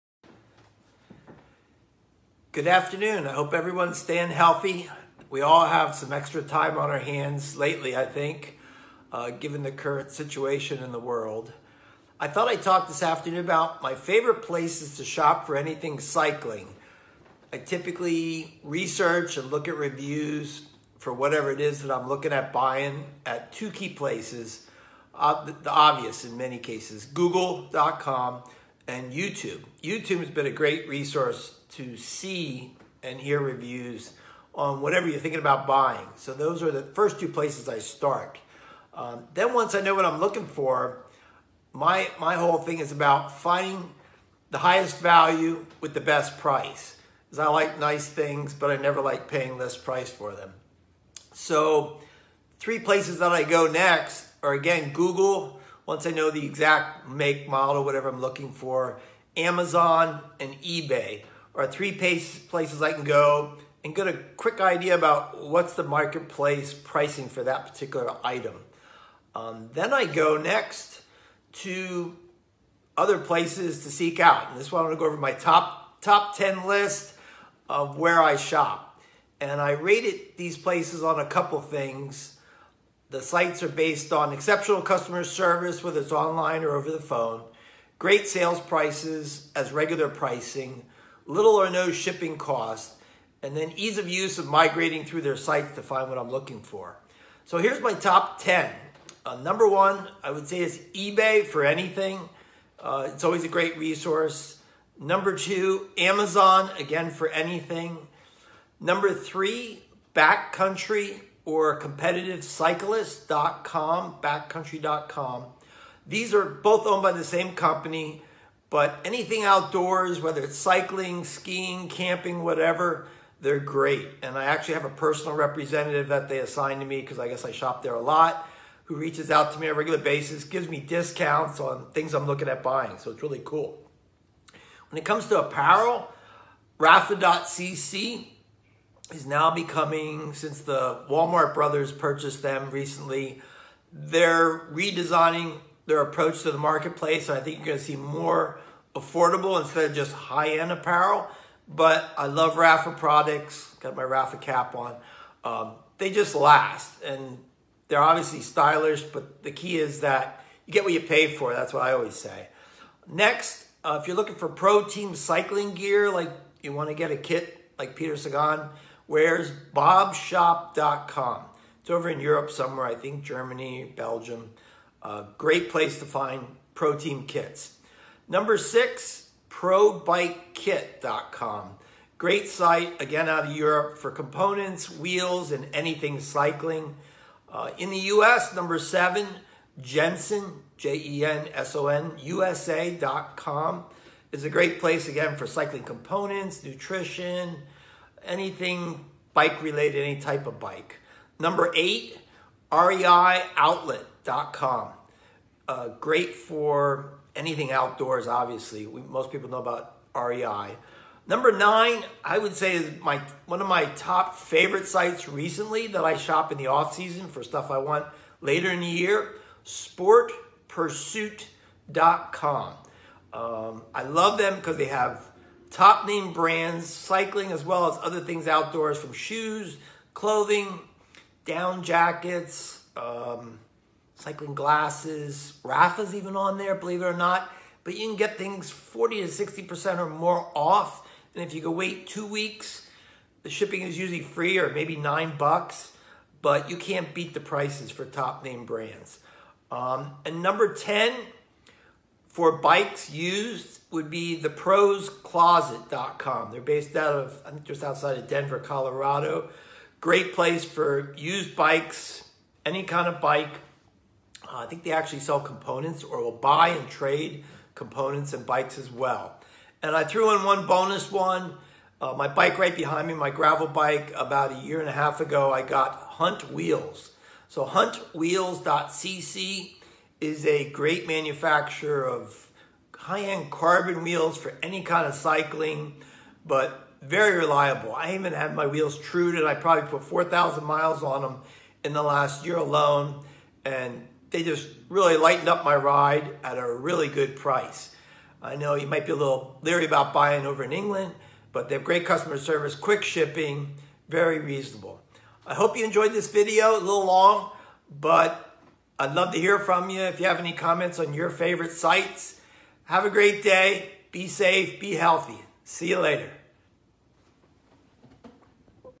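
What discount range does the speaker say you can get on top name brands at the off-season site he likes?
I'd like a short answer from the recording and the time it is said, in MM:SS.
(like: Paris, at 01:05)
40 to 60%, at 03:58.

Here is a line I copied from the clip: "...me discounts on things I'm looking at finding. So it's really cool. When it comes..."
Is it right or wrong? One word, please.
wrong.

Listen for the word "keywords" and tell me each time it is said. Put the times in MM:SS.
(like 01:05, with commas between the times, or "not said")
not said.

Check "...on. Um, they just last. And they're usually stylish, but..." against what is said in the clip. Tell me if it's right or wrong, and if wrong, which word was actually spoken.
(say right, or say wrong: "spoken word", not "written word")
wrong: "obviously", not "usually".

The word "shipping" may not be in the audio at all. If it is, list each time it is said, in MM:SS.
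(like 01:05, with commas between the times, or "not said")
01:31, 04:03, 05:03.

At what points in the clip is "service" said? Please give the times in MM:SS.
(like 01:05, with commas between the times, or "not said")
01:25, 05:02.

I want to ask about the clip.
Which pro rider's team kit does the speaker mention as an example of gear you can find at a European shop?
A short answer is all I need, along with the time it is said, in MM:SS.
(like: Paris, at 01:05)
Peter Sagan, at 02:47.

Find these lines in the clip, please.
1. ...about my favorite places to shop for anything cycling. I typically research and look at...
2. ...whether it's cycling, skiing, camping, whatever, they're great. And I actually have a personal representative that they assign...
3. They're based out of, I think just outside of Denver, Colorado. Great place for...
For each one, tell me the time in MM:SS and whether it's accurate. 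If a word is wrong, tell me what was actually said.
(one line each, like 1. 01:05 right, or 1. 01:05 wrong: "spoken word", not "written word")
1. 00:13 right
2. 02:00 right
3. 04:16 right.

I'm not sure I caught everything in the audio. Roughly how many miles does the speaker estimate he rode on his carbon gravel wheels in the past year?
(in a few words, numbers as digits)
4,000.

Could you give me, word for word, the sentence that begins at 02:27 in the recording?
So I think you're going to see more affordable instead of just high-end apparel.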